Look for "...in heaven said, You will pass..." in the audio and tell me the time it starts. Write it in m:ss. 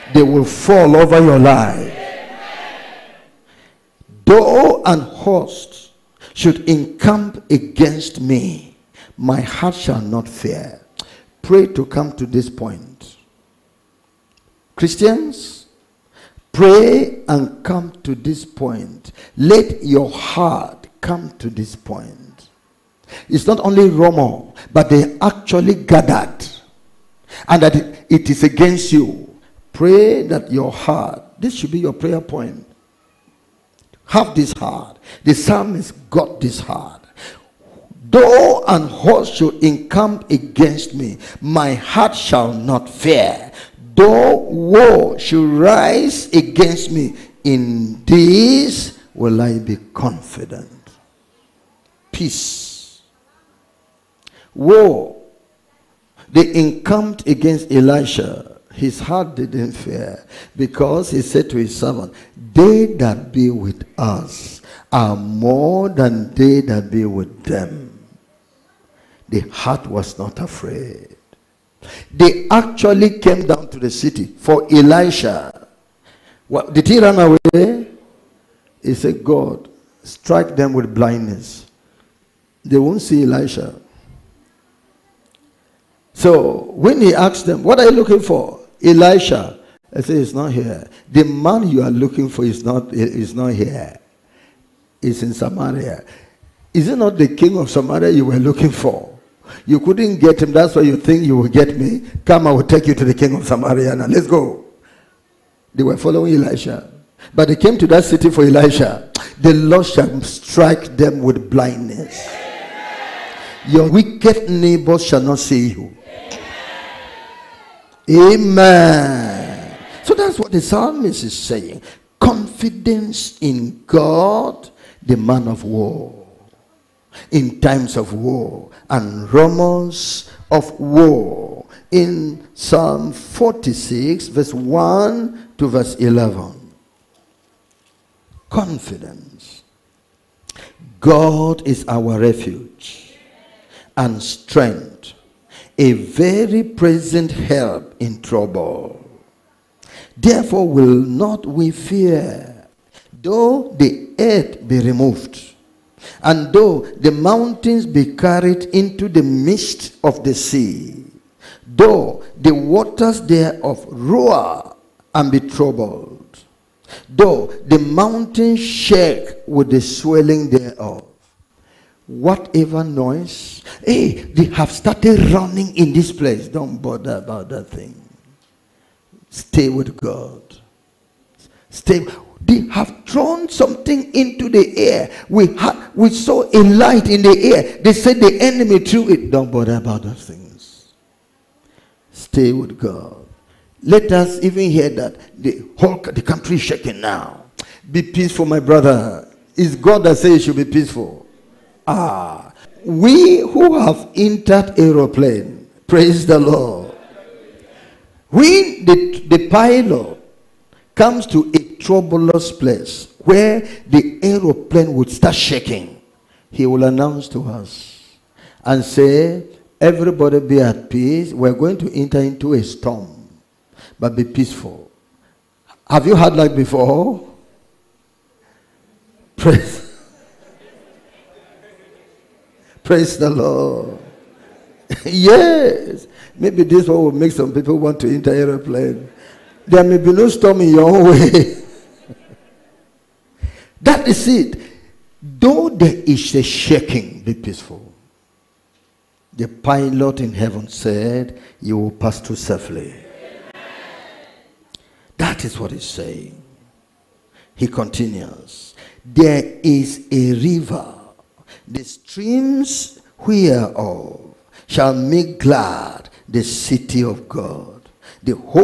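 4:10.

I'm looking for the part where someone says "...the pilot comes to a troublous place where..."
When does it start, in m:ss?
3:29.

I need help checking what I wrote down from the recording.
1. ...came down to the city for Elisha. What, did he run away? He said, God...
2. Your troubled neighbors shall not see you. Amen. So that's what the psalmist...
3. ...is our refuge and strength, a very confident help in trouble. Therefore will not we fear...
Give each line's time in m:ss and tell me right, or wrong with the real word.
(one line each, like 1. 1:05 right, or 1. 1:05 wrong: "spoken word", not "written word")
1. 1:13 right
2. 1:53 wrong: "wicked", not "troubled"
3. 2:21 wrong: "present", not "confident".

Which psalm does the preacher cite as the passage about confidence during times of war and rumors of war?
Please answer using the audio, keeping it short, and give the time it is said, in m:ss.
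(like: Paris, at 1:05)
Psalm 46, at 2:12.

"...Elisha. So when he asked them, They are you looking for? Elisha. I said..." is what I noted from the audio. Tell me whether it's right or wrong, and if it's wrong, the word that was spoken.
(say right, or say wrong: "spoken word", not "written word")
wrong: "What", not "They".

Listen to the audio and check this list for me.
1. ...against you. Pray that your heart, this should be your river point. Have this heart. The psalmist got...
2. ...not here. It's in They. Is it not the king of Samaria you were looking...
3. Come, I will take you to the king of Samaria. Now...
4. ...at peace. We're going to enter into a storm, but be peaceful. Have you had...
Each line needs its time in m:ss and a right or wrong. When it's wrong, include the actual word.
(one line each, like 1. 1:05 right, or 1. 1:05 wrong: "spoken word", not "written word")
1. 0:28 wrong: "prayer", not "river"
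2. 1:33 wrong: "Samaria", not "They"
3. 1:42 right
4. 3:40 right.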